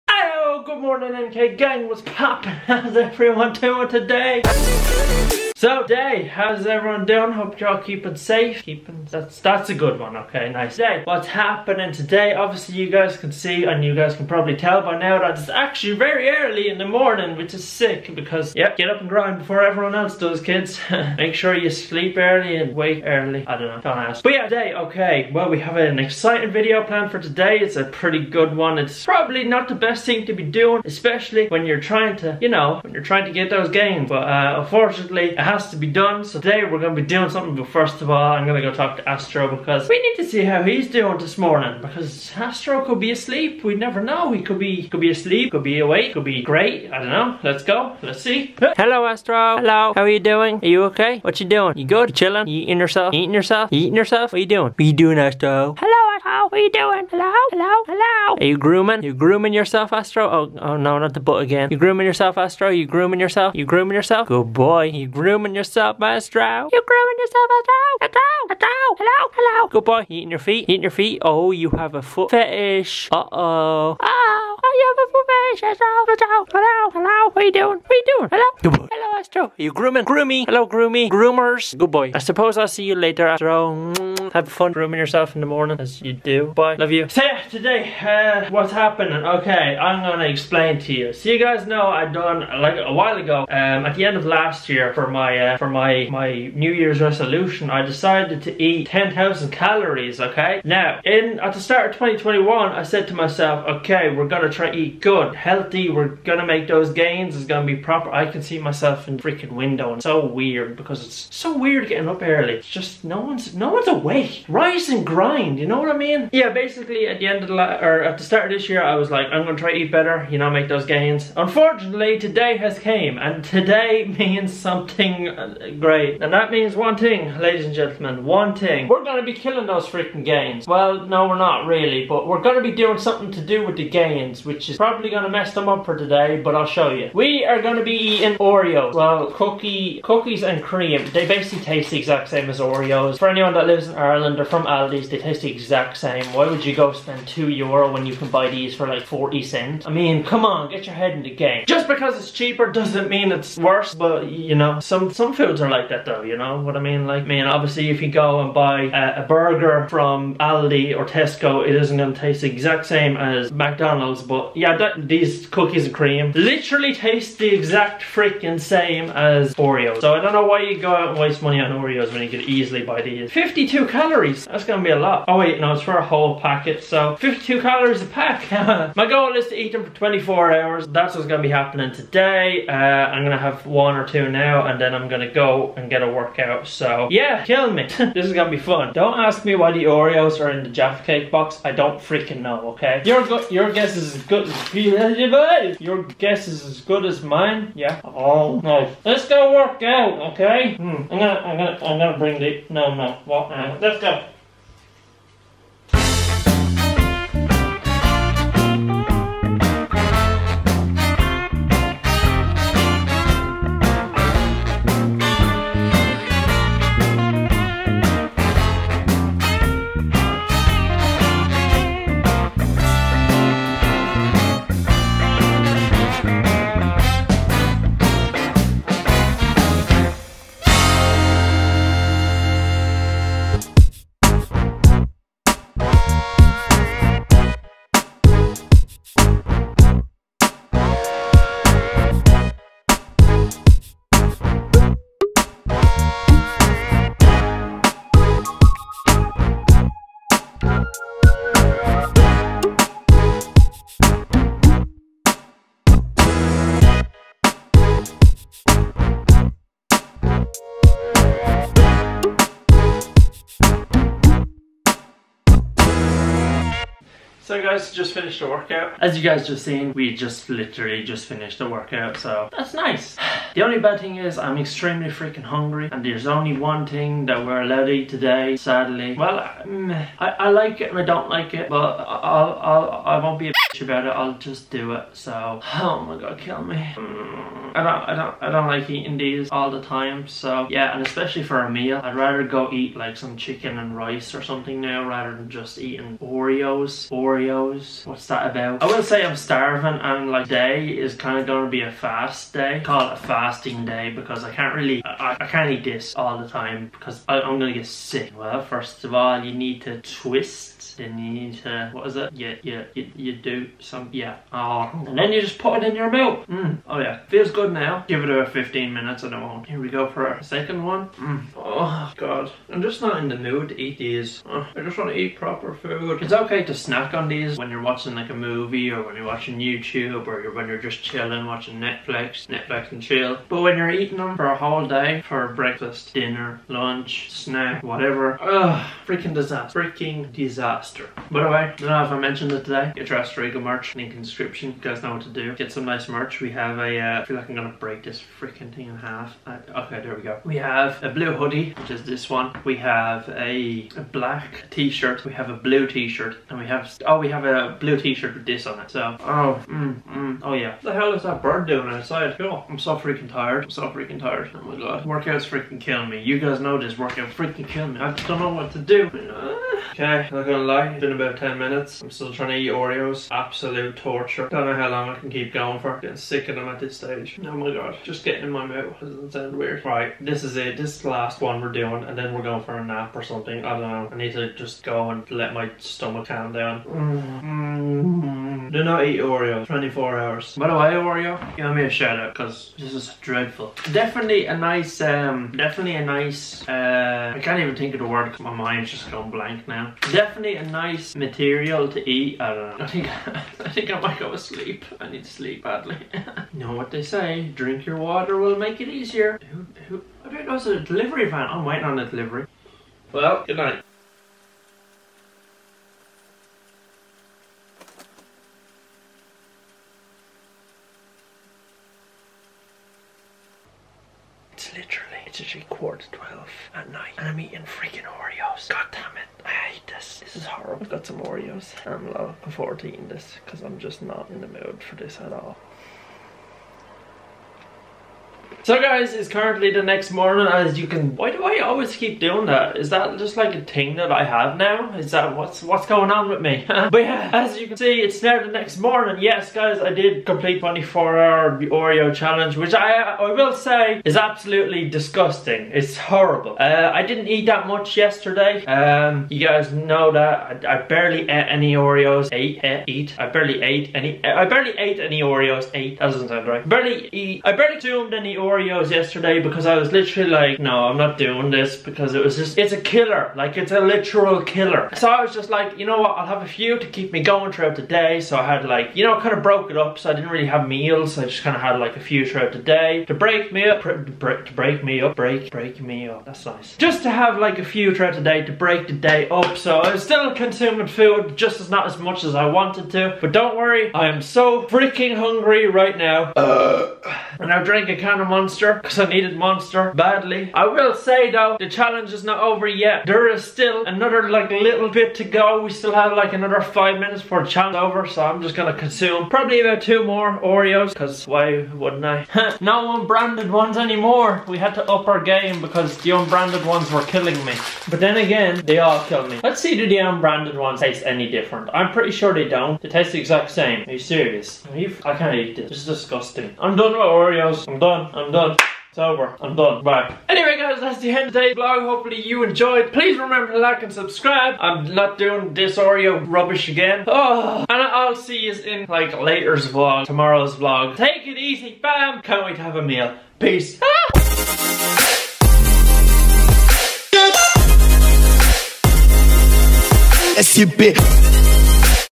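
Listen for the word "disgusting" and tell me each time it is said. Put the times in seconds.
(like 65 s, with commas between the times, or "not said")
454 s, 525 s.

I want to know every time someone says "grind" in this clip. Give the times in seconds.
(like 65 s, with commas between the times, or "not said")
19 s, 115 s.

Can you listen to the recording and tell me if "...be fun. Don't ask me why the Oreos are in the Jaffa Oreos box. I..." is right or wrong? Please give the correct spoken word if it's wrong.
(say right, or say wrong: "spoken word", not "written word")
wrong: "Cake", not "Oreos".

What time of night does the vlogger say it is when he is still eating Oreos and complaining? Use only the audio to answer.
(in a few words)
Quarter to 12.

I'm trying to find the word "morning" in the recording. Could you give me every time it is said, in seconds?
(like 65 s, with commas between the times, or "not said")
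0 s, 16 s, 41 s, 85 s, 440 s, 448 s.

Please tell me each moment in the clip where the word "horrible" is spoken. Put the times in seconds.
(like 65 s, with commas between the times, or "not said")
430 s, 455 s.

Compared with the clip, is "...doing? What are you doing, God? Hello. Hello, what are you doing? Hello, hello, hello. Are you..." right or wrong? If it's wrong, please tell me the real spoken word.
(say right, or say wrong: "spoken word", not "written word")
wrong: "Astro", not "God".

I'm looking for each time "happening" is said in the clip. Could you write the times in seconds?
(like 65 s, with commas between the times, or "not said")
11 s, 88 s, 181 s.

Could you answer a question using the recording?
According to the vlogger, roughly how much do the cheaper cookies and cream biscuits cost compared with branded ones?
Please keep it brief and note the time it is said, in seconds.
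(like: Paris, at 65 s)
40 cents, at 149 s.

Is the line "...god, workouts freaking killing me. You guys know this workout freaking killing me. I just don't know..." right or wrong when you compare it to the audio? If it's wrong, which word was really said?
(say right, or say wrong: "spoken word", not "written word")
right.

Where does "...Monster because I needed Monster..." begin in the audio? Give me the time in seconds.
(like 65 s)
498 s.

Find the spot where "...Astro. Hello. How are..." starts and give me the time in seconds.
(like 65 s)
49 s.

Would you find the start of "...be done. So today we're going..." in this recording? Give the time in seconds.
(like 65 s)
35 s.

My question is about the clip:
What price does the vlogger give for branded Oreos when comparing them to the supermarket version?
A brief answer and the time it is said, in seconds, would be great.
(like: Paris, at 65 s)
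2 euro, at 147 s.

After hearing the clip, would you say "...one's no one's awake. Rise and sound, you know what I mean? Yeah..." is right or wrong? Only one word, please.
wrong.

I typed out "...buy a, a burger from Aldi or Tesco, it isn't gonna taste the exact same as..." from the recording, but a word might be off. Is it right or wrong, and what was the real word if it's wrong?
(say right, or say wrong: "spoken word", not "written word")
right.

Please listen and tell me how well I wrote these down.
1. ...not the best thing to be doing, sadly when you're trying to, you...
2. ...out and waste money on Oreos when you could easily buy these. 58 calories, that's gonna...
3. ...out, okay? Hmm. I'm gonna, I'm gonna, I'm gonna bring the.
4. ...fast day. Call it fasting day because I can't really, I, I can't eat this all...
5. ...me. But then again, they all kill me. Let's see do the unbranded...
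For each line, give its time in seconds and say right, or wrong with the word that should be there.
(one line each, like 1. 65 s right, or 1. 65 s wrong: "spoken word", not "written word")
1. 29 s wrong: "especially", not "sadly"
2. 170 s wrong: "52", not "58"
3. 199 s right
4. 301 s right
5. 517 s right.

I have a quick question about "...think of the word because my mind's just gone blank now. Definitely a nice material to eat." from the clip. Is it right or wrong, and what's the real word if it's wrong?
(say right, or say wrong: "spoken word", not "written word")
right.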